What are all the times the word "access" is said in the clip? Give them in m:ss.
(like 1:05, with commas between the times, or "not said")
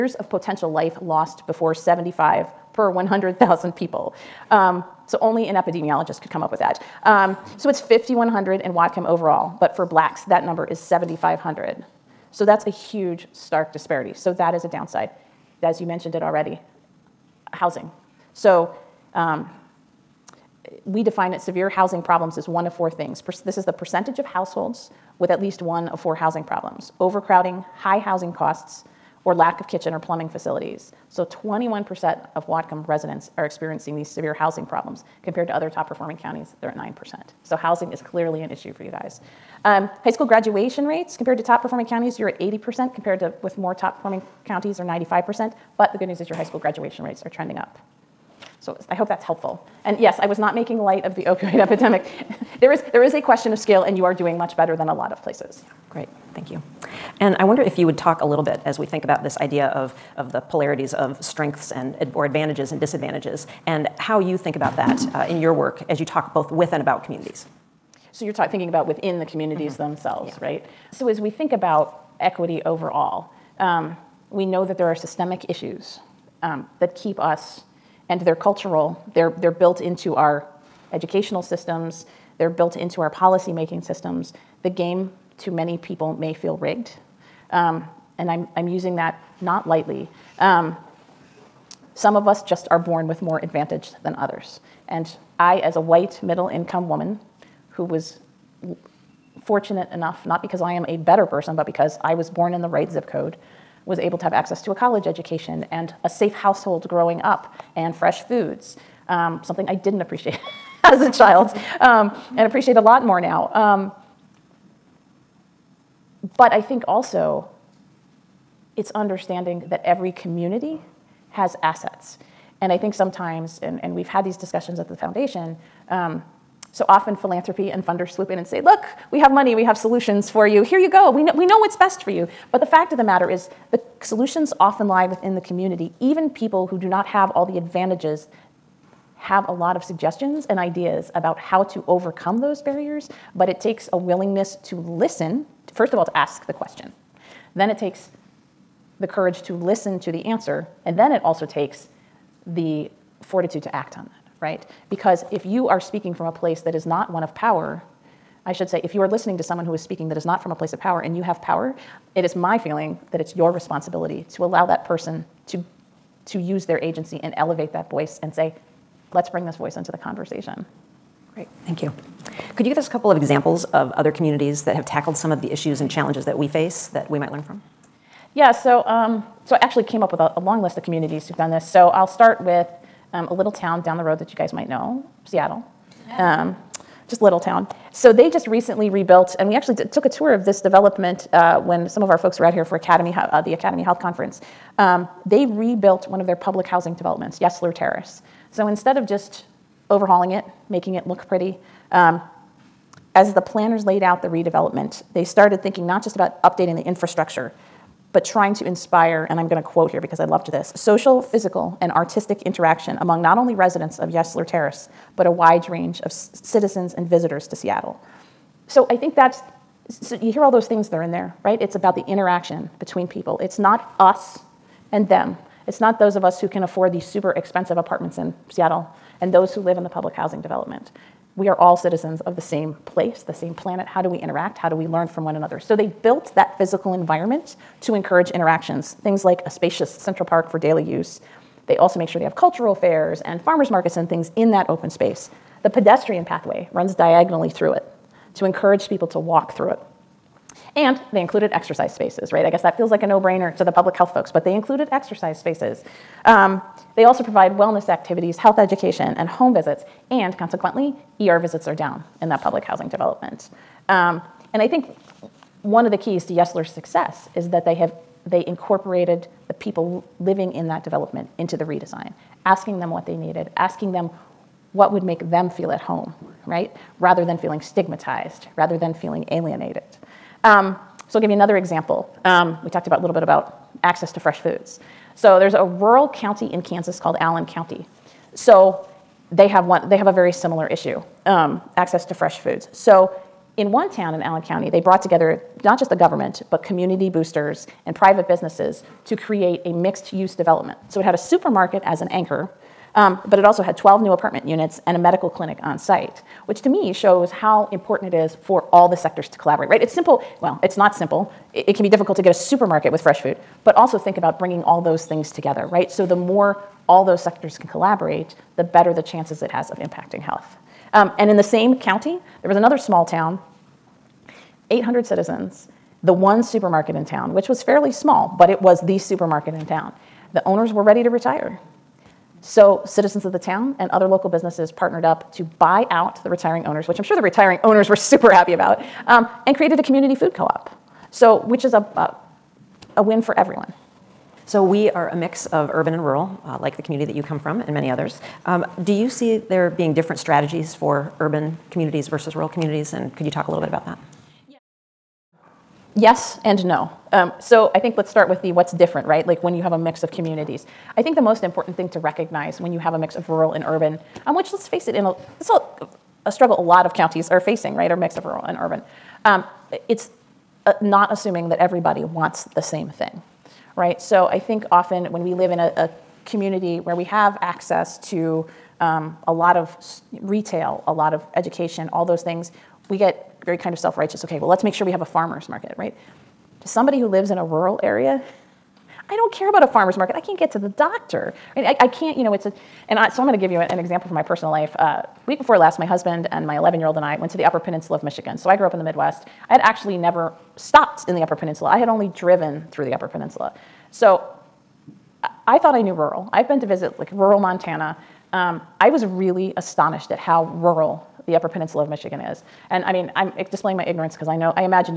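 1:44, 4:43, 4:51, 6:17.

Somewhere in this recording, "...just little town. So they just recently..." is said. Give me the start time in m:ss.
3:07.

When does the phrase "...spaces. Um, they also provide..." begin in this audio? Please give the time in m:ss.
4:15.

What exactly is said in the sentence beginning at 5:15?
So the more all those sectors can collaborate, the better the chances it has of impacting health.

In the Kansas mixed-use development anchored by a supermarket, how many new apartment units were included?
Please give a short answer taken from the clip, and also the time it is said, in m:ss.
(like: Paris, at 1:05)
12, at 5:03.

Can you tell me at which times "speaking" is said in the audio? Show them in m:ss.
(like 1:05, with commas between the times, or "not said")
2:35, 2:39.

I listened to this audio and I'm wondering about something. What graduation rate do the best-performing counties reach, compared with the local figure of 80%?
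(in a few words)
95%.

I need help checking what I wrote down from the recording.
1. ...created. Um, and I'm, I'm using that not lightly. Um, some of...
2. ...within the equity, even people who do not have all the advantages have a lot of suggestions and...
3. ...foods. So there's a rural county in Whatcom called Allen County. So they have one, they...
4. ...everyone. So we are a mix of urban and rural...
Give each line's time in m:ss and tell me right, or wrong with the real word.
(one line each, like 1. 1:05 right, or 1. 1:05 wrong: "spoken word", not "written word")
1. 1:26 wrong: "rigged", not "created"
2. 2:15 wrong: "community", not "equity"
3. 4:44 wrong: "Kansas", not "Whatcom"
4. 5:43 right.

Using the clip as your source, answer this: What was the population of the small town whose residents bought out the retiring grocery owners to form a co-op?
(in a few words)
800.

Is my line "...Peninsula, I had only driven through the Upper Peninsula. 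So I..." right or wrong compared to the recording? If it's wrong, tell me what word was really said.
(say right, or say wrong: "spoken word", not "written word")
right.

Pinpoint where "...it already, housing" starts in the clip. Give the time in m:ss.
0:16.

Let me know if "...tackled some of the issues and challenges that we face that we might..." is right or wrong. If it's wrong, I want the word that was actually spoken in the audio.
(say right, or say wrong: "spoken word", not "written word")
right.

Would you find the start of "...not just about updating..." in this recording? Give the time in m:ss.
3:25.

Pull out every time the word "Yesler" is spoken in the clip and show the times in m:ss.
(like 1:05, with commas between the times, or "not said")
3:17, 3:34, 4:26.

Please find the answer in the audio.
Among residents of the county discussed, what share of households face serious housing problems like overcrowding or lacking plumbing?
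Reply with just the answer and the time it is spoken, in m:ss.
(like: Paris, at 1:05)
21%, at 0:31.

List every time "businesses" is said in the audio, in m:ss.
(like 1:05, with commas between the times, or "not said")
4:58, 5:34.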